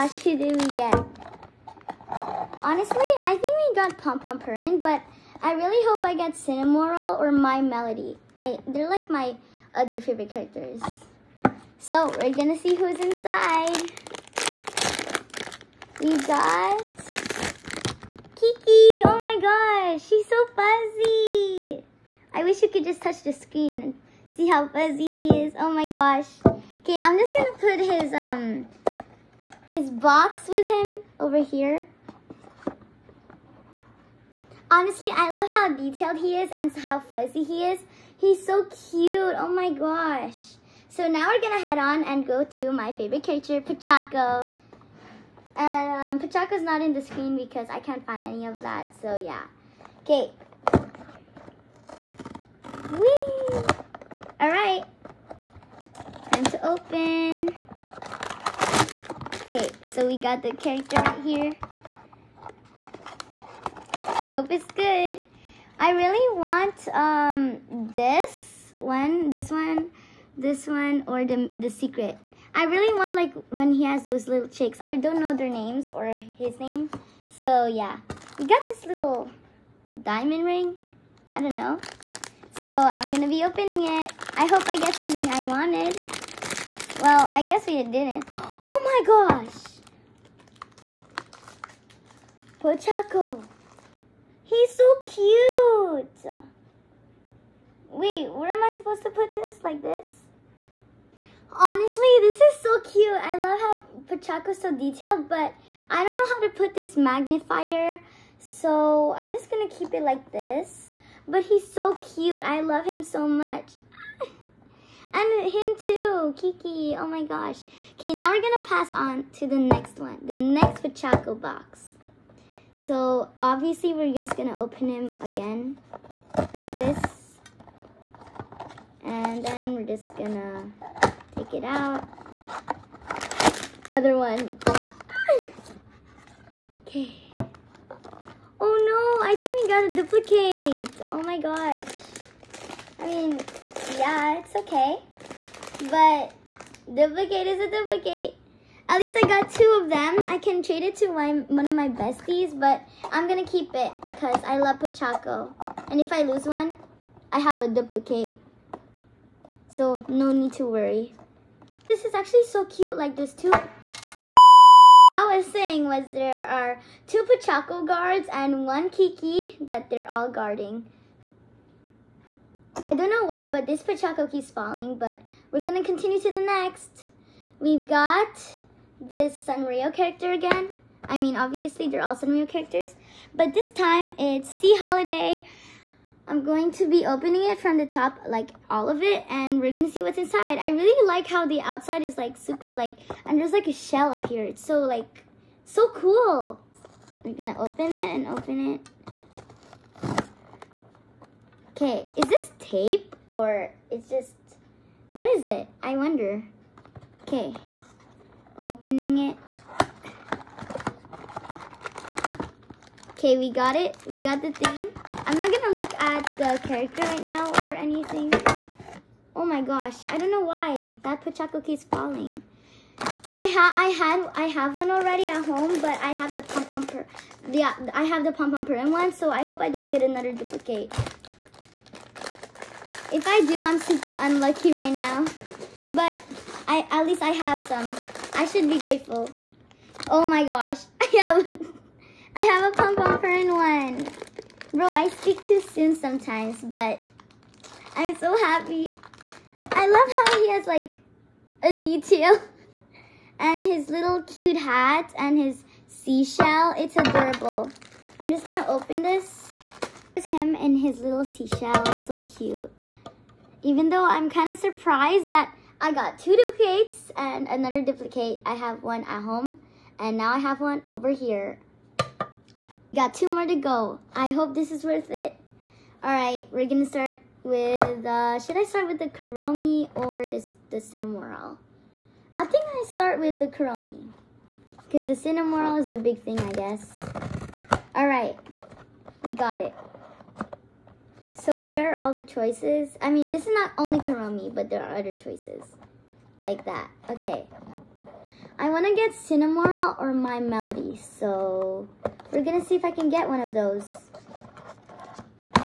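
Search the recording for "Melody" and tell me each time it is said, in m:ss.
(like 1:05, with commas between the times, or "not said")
0:07, 5:00.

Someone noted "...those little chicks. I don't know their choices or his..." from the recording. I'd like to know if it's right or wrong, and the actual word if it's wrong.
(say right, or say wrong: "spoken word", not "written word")
wrong: "names", not "choices".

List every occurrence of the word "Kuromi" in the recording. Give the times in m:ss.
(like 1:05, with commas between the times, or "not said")
4:39, 4:43, 4:53.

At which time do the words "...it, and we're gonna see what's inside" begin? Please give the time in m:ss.
3:09.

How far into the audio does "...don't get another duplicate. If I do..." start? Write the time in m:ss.
3:49.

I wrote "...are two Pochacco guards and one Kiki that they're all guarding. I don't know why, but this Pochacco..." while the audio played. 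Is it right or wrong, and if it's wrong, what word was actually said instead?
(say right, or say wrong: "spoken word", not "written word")
right.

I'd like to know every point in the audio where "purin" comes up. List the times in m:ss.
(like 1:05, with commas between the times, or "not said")
0:04, 3:48.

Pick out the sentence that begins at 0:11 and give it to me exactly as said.
So, we're gonna see who's inside.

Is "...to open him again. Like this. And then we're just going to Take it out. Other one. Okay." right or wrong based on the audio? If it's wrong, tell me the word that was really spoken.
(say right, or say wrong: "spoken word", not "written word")
right.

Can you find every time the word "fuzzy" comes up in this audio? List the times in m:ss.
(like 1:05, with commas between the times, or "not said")
0:20, 0:24, 0:37.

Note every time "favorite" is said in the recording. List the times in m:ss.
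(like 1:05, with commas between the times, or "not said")
0:10, 0:42.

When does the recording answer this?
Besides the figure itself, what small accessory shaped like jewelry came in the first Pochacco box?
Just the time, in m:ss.
1:20.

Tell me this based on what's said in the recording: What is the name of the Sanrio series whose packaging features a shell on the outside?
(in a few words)
Sea Holiday.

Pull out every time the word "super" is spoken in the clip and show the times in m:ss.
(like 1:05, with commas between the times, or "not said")
3:12, 3:53.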